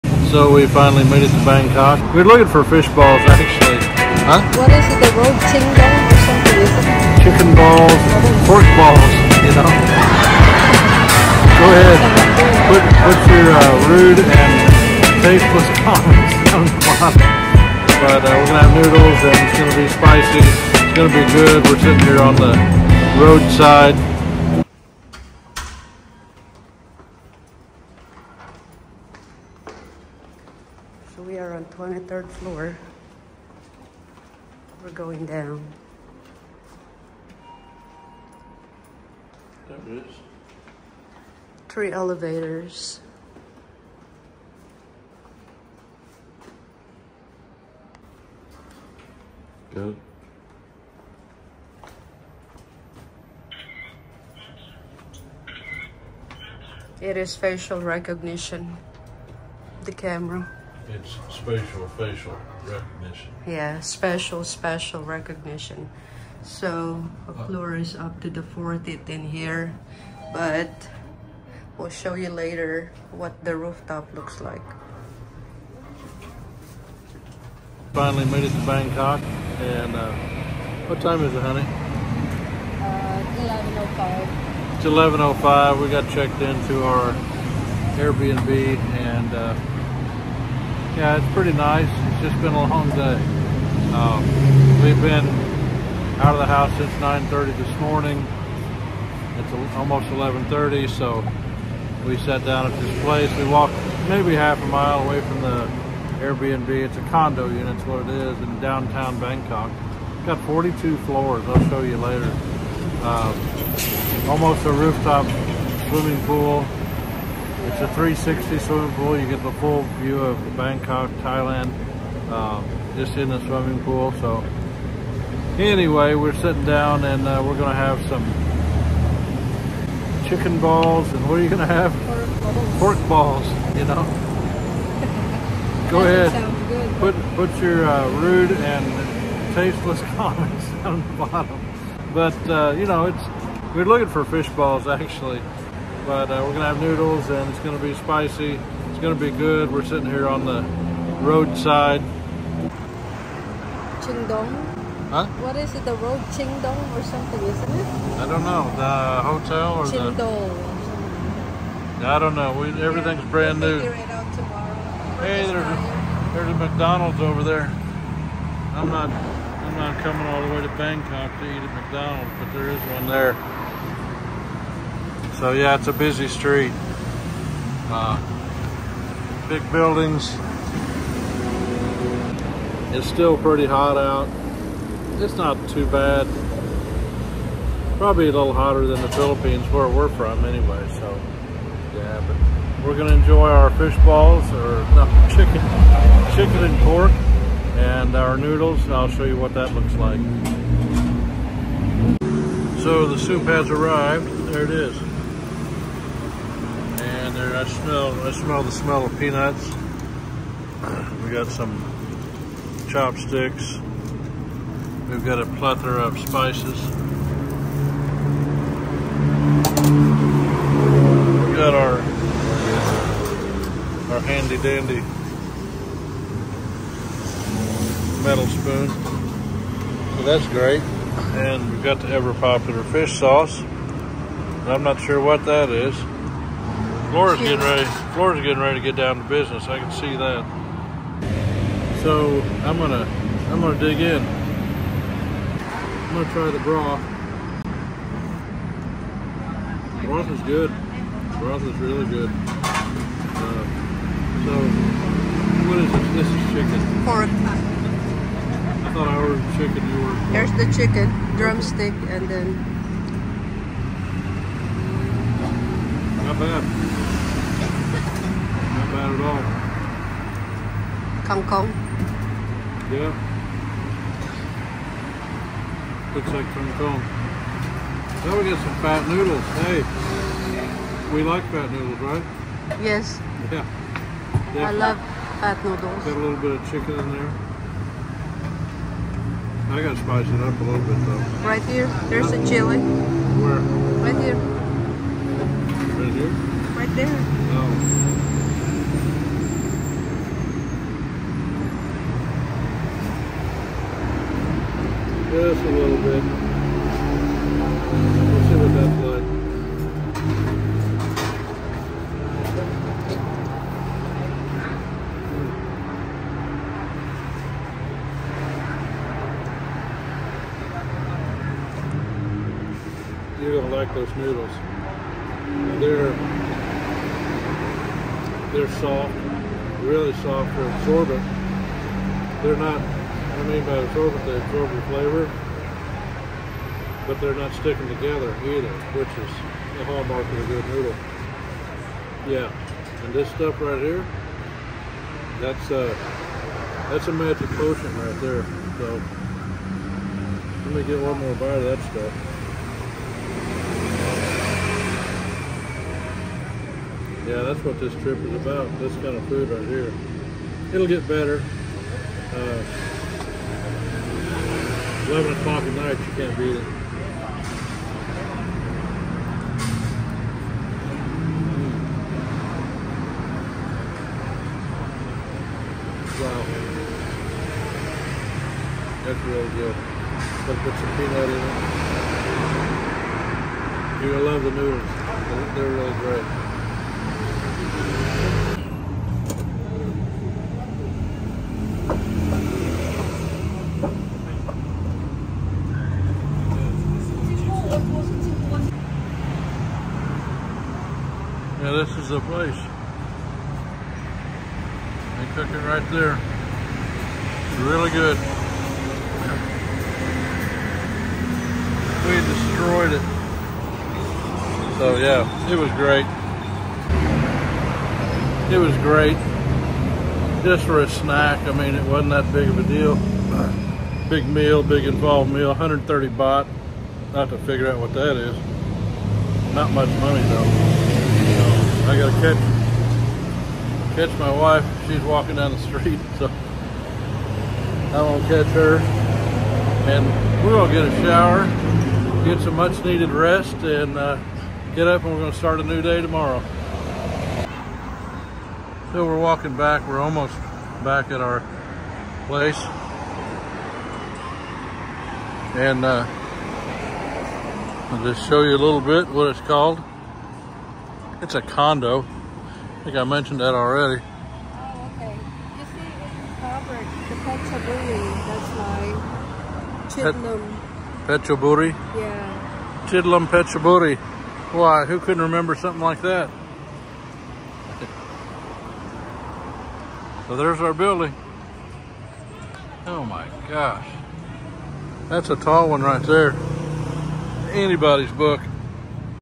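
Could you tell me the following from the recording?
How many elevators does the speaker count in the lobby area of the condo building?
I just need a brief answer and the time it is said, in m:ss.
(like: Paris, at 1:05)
3, at 0:41.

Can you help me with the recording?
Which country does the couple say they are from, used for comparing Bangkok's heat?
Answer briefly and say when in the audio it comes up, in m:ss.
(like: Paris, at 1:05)
Philippines, at 3:09.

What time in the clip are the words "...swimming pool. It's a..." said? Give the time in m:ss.
1:55.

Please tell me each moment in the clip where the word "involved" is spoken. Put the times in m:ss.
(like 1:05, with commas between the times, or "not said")
7:04.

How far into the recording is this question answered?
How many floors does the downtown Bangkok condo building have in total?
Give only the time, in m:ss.
1:50.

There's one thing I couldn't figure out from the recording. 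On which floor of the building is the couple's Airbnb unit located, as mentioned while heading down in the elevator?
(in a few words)
23rd floor.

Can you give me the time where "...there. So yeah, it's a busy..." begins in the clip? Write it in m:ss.
2:53.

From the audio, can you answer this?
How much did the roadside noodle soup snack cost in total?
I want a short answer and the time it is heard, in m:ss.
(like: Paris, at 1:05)
130 baht, at 7:05.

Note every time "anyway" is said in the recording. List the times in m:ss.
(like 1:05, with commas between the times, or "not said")
2:05, 3:10.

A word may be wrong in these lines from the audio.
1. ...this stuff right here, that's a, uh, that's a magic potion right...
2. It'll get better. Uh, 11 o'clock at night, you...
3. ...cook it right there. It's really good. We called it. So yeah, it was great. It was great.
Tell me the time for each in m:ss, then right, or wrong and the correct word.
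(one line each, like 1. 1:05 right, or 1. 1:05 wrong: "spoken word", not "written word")
1. 5:43 right
2. 6:00 right
3. 6:45 wrong: "destroyed", not "called".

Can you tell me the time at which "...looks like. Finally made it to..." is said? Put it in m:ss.
1:14.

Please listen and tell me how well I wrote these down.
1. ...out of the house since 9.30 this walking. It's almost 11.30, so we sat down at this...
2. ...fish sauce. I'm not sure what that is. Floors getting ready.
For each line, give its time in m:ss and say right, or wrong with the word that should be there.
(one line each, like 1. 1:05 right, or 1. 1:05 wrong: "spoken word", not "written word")
1. 1:36 wrong: "morning", not "walking"
2. 3:52 right.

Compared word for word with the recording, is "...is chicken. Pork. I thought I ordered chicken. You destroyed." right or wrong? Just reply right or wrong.
wrong.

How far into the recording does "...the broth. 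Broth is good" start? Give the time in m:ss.
4:06.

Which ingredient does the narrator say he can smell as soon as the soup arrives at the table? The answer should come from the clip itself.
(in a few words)
Peanuts.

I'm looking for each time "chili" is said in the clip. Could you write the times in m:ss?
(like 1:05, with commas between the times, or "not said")
4:52.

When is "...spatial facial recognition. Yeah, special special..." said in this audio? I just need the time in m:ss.
1:01.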